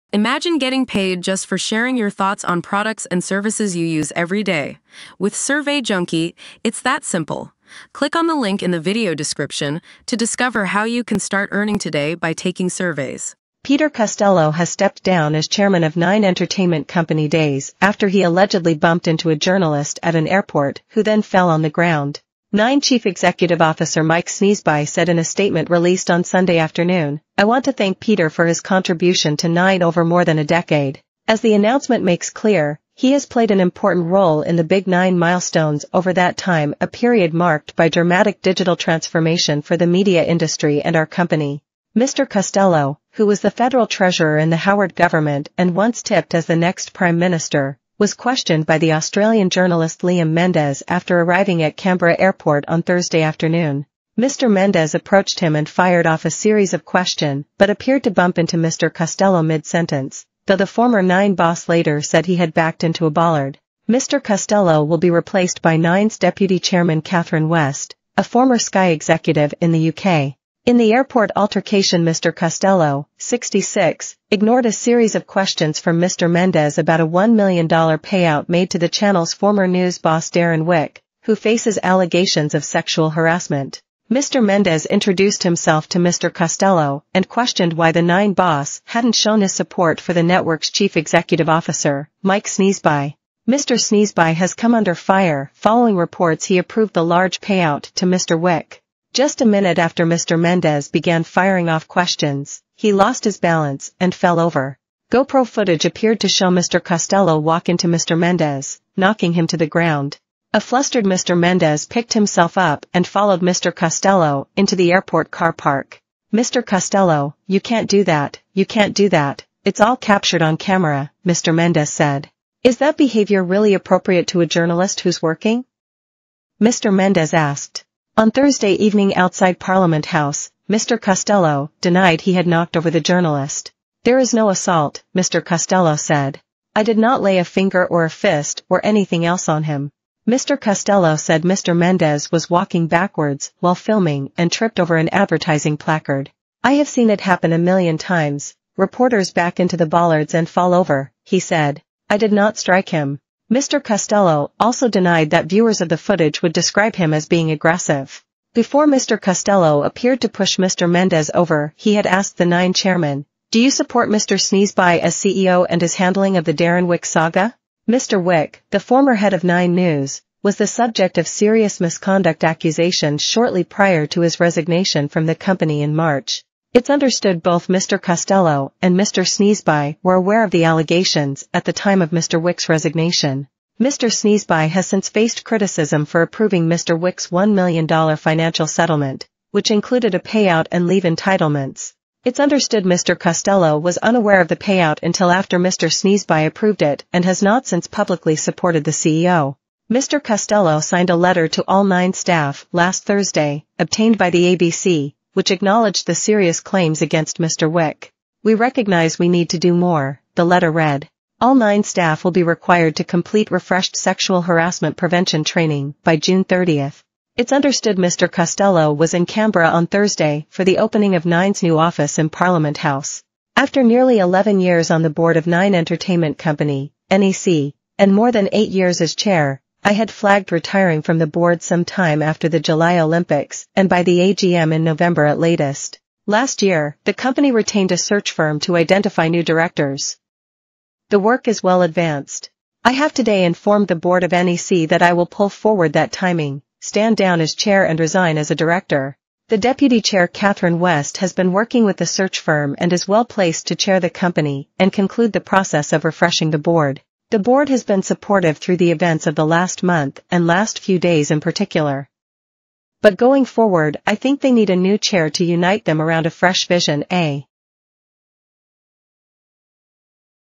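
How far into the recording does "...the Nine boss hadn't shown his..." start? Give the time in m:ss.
1:27.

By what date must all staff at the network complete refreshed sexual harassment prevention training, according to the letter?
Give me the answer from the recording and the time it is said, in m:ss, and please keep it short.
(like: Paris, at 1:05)
June 30th, at 3:36.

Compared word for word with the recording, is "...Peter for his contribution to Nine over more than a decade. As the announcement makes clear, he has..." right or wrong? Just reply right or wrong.
right.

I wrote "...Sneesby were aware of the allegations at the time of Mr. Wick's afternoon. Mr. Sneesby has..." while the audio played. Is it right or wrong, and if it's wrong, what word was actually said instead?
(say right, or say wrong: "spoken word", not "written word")
wrong: "resignation", not "afternoon".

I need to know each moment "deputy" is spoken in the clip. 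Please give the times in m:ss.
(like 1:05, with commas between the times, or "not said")
1:06, 4:09.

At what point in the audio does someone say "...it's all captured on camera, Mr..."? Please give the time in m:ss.
1:59.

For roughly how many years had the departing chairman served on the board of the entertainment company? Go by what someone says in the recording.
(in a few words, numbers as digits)
11 years.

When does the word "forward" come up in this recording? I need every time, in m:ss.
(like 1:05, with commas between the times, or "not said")
4:05, 4:23.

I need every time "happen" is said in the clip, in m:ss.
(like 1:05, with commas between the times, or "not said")
2:27.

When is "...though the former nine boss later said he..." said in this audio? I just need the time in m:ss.
1:00.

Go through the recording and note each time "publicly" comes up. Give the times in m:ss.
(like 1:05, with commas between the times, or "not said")
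3:17.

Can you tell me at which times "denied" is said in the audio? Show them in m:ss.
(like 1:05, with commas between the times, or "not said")
2:11, 2:34.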